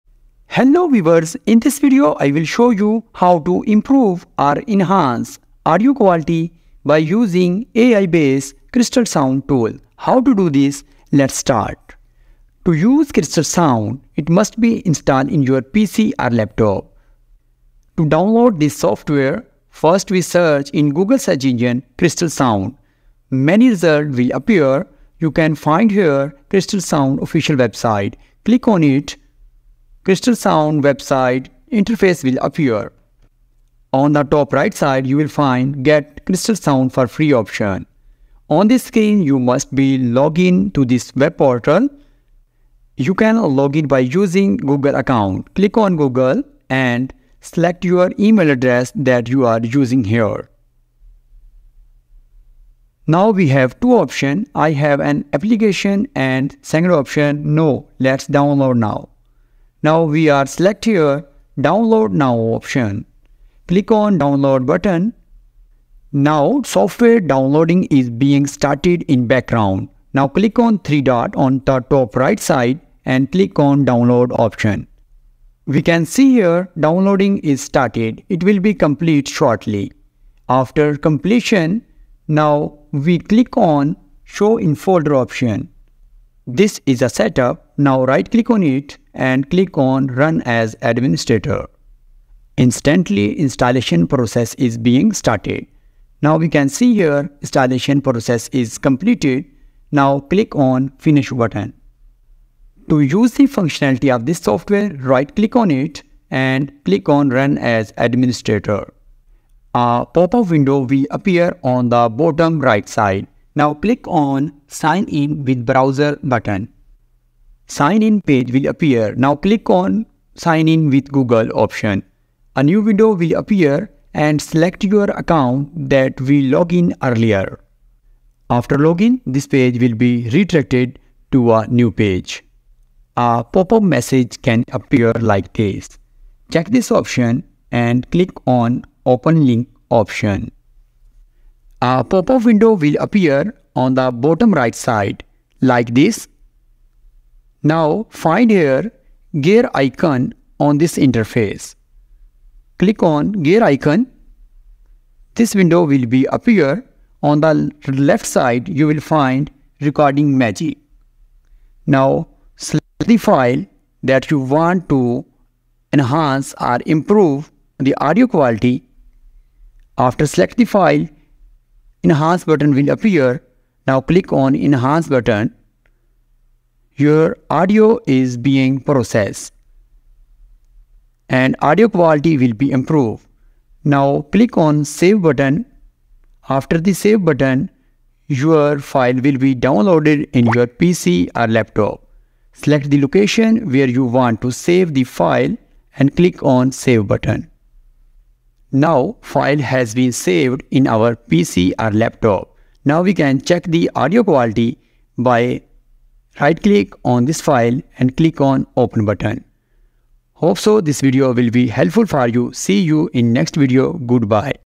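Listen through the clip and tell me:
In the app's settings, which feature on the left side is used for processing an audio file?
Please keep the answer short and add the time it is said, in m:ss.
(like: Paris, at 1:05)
recording magic, at 2:39.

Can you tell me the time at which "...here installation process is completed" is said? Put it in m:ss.
1:36.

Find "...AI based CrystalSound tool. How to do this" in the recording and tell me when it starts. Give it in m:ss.
0:07.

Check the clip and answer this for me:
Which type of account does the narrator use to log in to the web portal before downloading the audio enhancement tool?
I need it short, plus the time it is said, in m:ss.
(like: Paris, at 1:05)
Google account, at 0:44.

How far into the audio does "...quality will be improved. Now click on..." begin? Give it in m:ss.
3:01.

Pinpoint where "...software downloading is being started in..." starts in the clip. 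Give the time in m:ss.
1:06.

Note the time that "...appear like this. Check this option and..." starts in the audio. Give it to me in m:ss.
2:14.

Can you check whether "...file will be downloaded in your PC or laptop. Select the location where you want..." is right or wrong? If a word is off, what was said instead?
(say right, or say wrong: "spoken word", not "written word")
right.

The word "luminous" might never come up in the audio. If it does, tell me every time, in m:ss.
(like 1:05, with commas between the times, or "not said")
not said.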